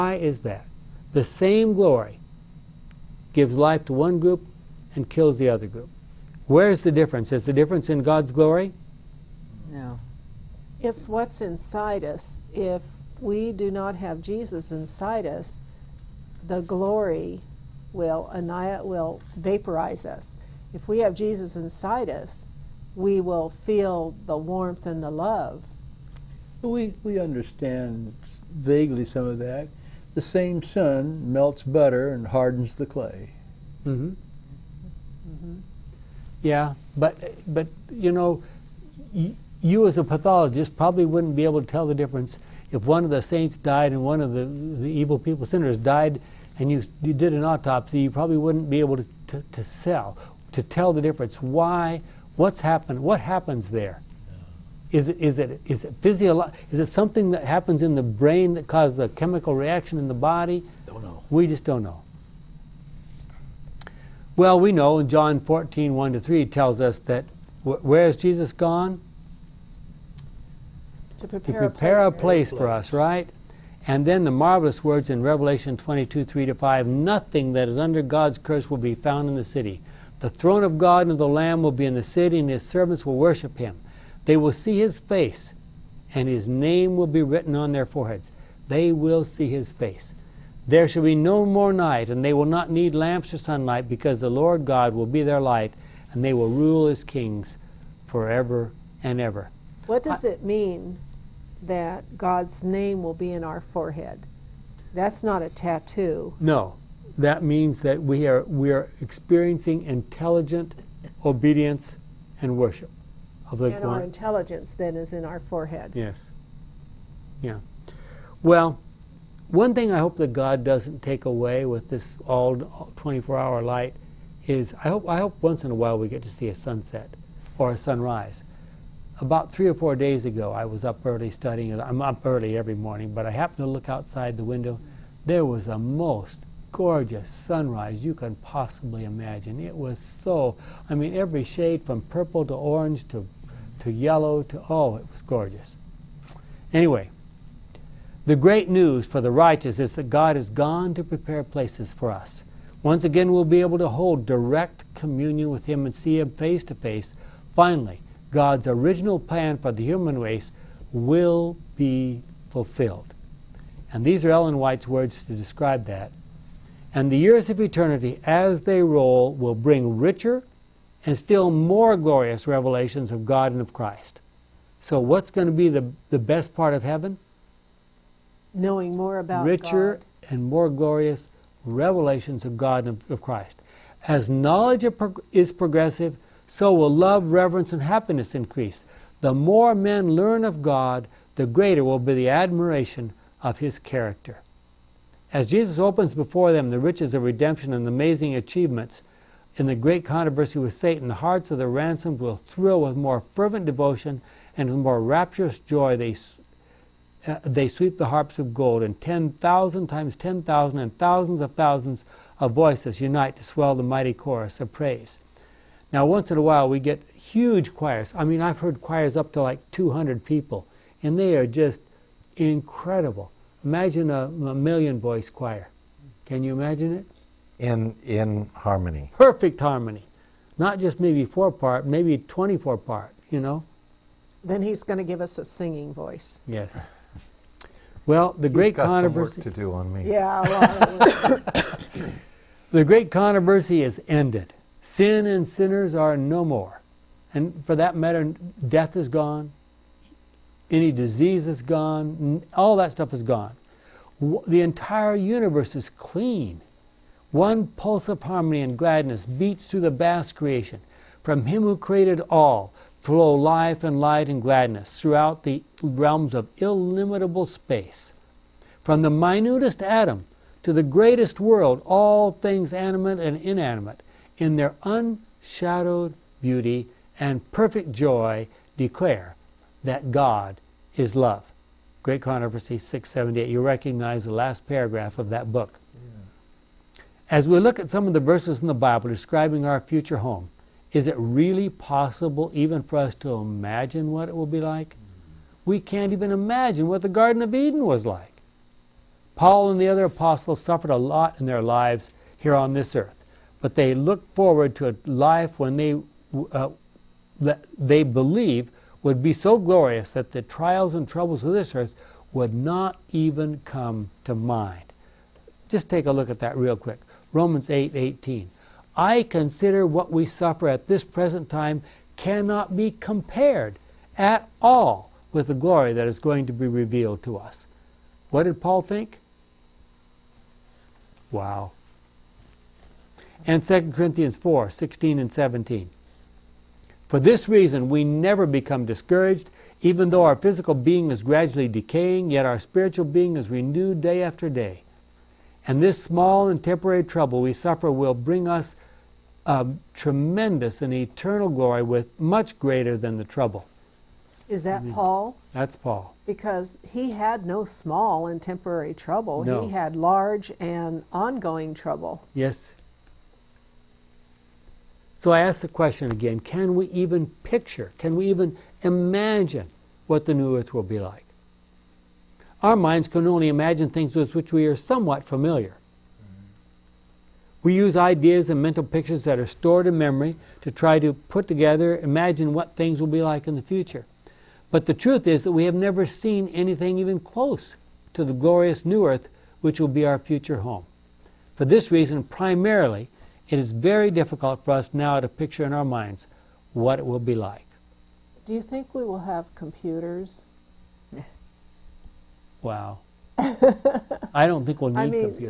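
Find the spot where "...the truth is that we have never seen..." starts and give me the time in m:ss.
6:24.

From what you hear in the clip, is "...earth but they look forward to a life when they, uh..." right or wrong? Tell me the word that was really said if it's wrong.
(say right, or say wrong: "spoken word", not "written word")
right.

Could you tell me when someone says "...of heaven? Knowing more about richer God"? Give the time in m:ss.
2:56.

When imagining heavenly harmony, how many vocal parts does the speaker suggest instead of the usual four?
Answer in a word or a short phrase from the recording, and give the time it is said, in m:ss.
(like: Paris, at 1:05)
24, at 3:52.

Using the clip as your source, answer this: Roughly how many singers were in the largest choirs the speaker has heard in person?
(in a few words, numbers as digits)
200.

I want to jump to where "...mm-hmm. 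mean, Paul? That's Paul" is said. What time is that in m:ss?
5:54.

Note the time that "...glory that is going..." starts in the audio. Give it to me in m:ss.
5:25.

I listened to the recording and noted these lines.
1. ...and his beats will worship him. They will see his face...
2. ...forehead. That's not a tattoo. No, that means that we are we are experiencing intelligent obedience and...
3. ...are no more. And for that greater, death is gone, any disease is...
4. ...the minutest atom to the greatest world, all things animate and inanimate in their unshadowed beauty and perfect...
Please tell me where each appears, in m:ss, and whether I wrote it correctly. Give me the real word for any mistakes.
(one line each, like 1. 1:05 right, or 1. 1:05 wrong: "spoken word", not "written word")
1. 1:22 wrong: "servants", not "beats"
2. 1:43 right
3. 4:05 wrong: "matter", not "greater"
4. 4:29 right.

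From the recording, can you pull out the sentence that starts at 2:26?
Anyway, the great news for the righteous is that God has gone to prepare places for us.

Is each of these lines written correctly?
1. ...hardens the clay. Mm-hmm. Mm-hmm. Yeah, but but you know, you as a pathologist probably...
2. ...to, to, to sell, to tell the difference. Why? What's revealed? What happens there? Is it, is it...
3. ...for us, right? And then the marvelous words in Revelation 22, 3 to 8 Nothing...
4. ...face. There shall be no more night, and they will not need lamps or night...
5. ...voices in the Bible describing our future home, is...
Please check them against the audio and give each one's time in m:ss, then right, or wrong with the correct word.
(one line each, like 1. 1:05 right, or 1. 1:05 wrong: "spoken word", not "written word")
1. 0:32 right
2. 0:48 wrong: "happened", not "revealed"
3. 1:12 wrong: "5", not "8"
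4. 1:29 wrong: "sunlight", not "night"
5. 4:48 wrong: "verses", not "voices".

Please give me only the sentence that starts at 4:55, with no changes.
We can't even imagine what the Garden of Eden was like.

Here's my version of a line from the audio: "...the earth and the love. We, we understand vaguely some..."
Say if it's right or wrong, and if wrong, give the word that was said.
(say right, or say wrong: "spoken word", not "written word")
wrong: "warmth", not "earth".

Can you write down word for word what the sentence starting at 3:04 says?
As knowledge is progressive, so will love, reverence, and happiness increase.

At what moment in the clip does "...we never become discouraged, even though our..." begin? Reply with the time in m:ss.
5:37.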